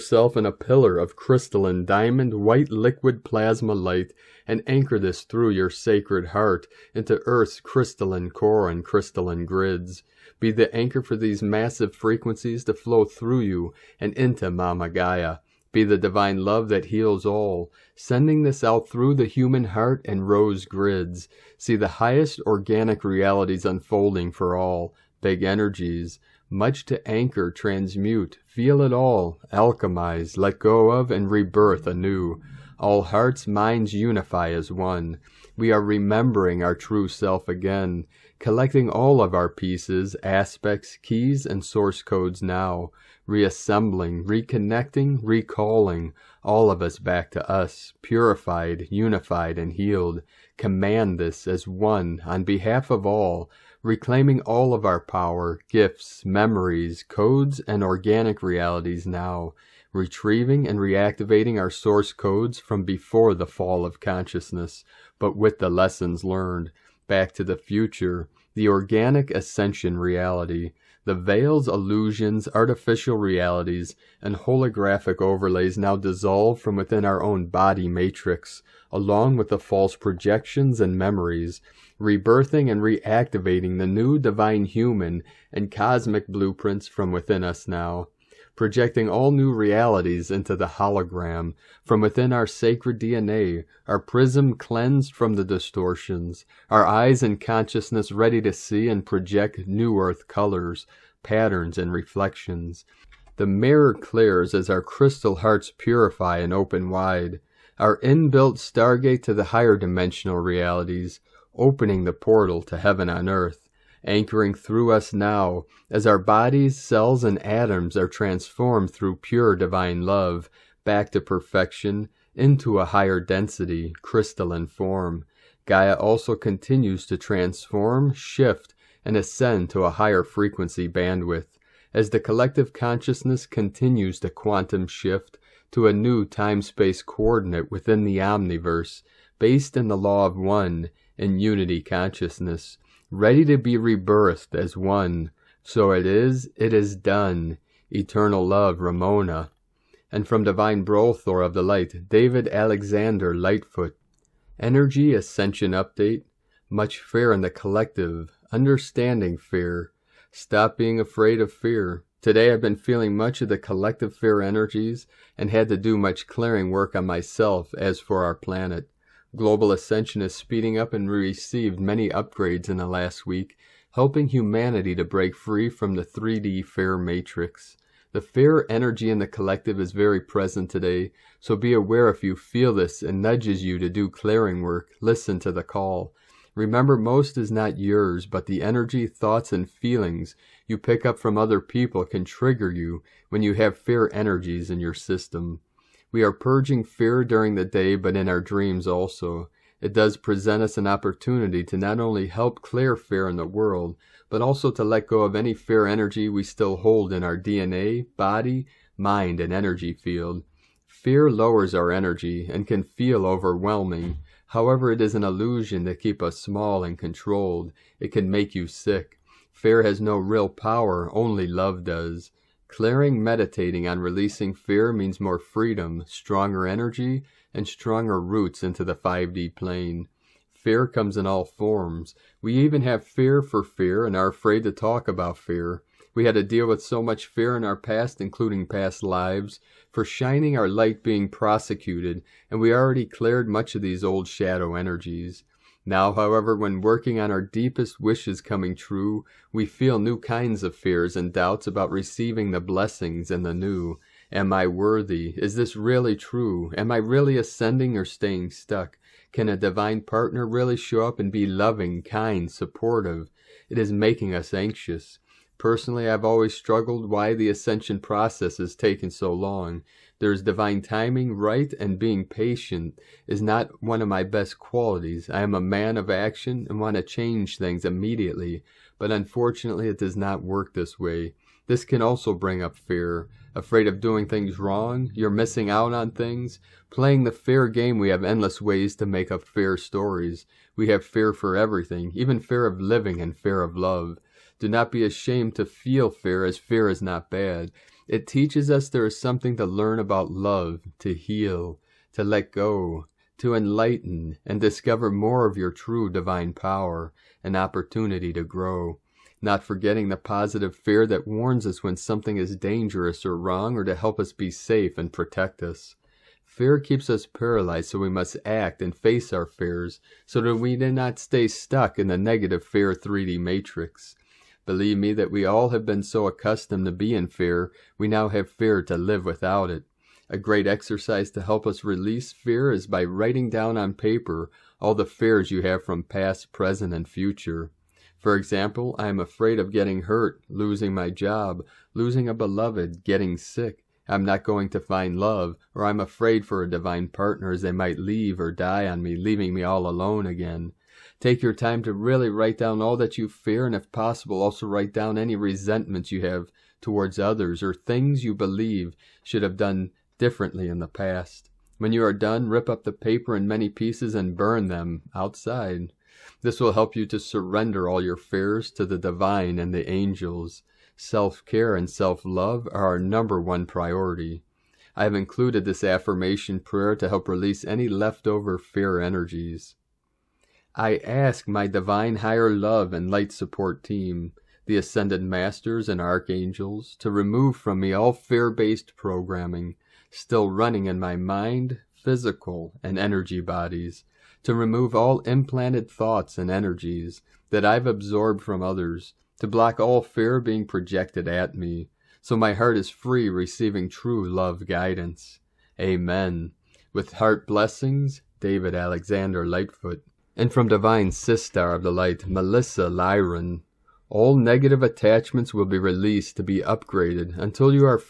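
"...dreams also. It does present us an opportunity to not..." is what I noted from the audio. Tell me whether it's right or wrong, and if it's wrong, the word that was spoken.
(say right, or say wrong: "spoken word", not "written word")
right.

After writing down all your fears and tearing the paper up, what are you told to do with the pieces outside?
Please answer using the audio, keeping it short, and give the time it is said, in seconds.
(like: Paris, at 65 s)
Burn them, at 364 s.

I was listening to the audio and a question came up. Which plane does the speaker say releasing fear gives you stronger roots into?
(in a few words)
5D plane.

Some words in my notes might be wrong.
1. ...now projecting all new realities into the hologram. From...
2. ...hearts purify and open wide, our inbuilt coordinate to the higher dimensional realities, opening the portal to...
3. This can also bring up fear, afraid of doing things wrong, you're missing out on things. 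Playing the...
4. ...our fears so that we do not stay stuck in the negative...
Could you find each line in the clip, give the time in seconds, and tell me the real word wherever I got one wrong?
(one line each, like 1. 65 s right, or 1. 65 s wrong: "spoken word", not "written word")
1. 87 s right
2. 105 s wrong: "stargate", not "coordinate"
3. 281 s right
4. 319 s right.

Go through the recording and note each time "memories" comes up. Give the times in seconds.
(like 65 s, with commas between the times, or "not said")
56 s, 80 s.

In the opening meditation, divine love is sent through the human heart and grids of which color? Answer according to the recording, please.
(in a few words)
Rose.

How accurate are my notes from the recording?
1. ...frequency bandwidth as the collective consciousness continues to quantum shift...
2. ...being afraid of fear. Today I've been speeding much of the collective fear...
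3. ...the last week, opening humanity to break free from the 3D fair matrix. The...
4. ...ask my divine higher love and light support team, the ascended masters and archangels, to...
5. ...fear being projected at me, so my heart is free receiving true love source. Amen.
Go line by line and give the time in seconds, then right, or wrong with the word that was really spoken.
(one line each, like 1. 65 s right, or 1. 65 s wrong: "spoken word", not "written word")
1. 130 s right
2. 160 s wrong: "feeling", not "speeding"
3. 172 s wrong: "helping", not "opening"
4. 381 s right
5. 400 s wrong: "guidance", not "source".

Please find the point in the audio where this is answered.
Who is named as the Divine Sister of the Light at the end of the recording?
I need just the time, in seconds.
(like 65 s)
412 s.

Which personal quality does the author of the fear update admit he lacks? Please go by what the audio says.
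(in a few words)
Being patient.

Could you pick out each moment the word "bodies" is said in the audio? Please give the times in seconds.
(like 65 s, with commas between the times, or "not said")
116 s, 393 s.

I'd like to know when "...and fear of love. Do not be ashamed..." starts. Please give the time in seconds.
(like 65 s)
293 s.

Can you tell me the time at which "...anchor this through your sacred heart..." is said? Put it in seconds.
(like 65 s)
4 s.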